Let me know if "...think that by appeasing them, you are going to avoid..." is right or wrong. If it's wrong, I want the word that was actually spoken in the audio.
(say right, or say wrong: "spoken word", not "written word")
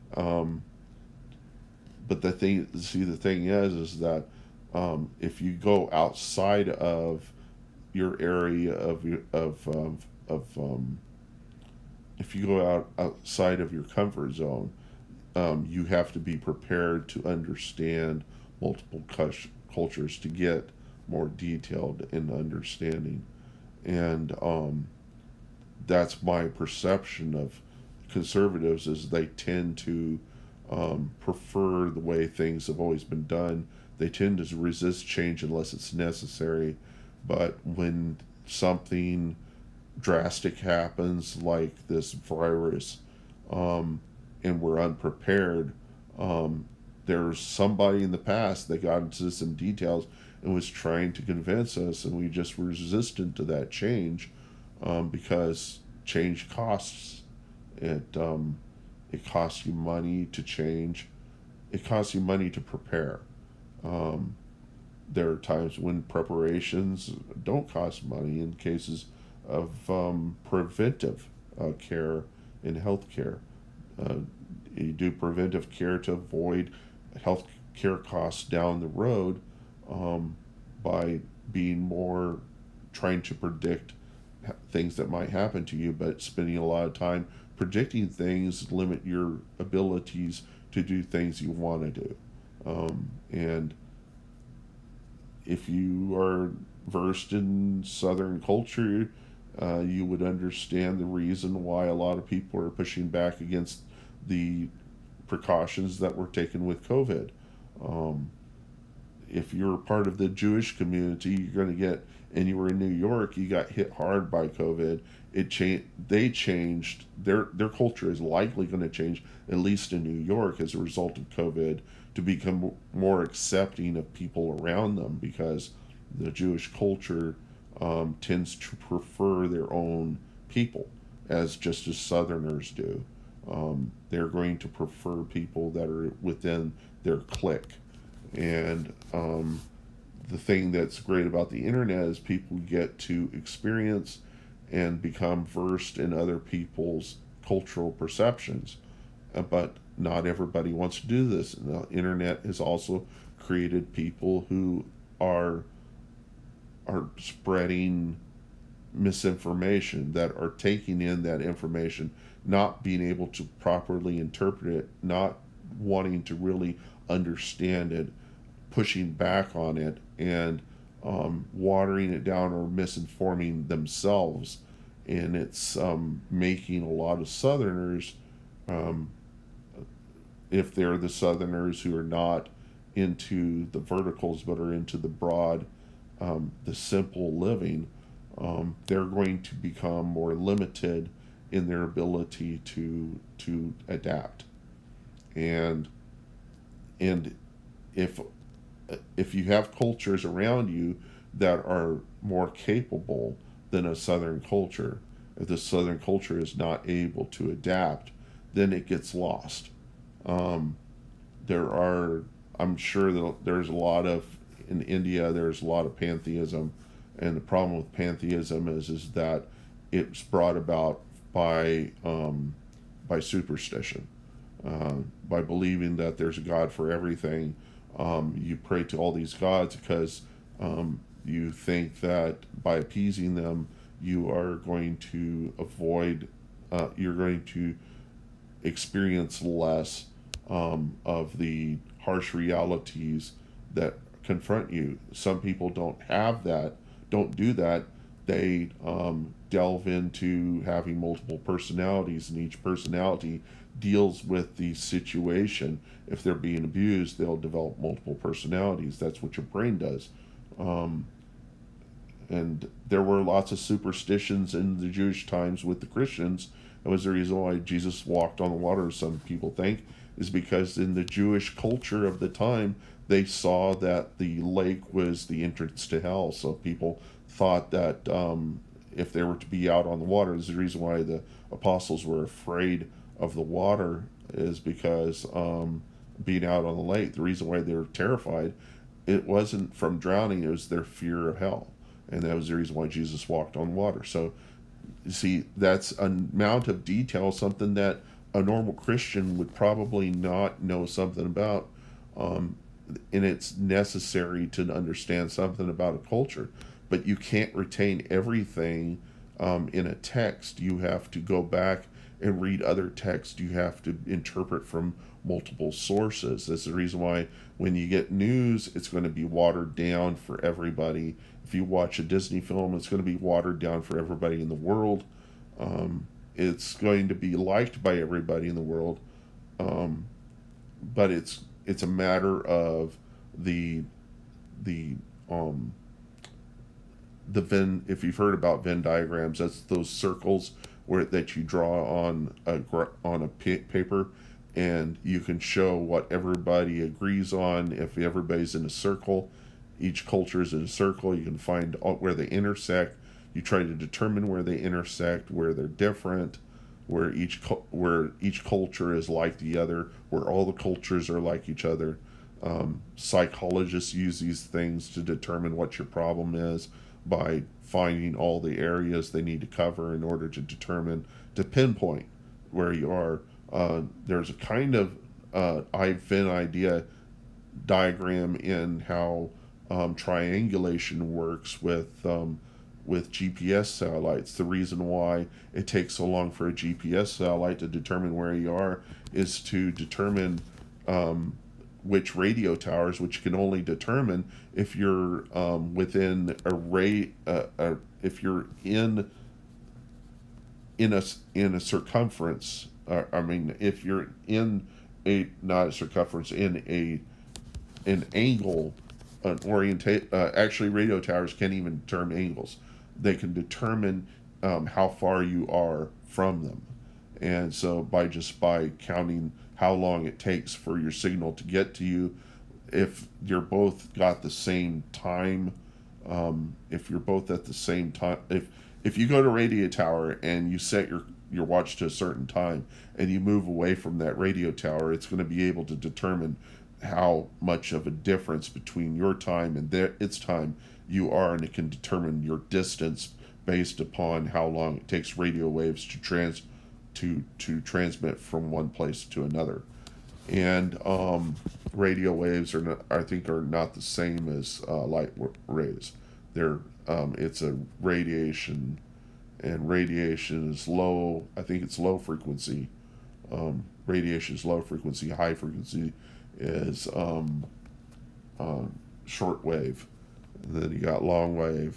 right.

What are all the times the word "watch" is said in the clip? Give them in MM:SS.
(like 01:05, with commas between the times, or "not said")
05:21, 07:11.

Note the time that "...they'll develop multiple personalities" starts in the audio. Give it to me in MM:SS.
04:17.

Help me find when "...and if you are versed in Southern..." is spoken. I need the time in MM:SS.
01:33.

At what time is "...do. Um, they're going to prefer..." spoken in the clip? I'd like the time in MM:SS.
02:12.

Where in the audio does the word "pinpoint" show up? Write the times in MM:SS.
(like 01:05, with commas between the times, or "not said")
06:11.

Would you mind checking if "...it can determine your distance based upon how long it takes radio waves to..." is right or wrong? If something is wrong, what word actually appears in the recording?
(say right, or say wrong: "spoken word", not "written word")
right.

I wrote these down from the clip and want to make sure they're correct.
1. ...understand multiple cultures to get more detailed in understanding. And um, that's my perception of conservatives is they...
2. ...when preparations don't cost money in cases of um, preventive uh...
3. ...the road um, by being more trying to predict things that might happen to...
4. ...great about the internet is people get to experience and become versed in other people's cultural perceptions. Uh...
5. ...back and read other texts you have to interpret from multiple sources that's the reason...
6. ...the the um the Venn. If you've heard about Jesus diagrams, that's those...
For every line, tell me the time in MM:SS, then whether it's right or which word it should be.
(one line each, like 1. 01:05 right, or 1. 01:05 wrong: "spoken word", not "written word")
1. 00:17 right
2. 01:05 right
3. 01:18 right
4. 02:20 right
5. 05:11 right
6. 05:33 wrong: "Venn", not "Jesus".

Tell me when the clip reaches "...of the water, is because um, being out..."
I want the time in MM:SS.
04:43.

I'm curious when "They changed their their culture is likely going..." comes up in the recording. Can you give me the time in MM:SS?
01:56.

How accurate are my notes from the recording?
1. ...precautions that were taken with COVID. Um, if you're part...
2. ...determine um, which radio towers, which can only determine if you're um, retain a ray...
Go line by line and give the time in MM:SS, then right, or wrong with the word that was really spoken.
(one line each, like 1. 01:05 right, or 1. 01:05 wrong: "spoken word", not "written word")
1. 01:45 right
2. 06:29 wrong: "within", not "retain".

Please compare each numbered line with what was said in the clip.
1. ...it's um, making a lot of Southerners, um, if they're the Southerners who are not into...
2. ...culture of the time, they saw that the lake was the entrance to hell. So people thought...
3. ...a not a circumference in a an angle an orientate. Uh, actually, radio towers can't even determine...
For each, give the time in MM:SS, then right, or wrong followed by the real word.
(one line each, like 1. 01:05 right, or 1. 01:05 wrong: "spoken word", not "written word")
1. 02:55 right
2. 04:31 right
3. 06:45 right.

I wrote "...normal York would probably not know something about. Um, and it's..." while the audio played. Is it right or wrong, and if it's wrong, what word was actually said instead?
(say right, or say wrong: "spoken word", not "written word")
wrong: "Christian", not "York".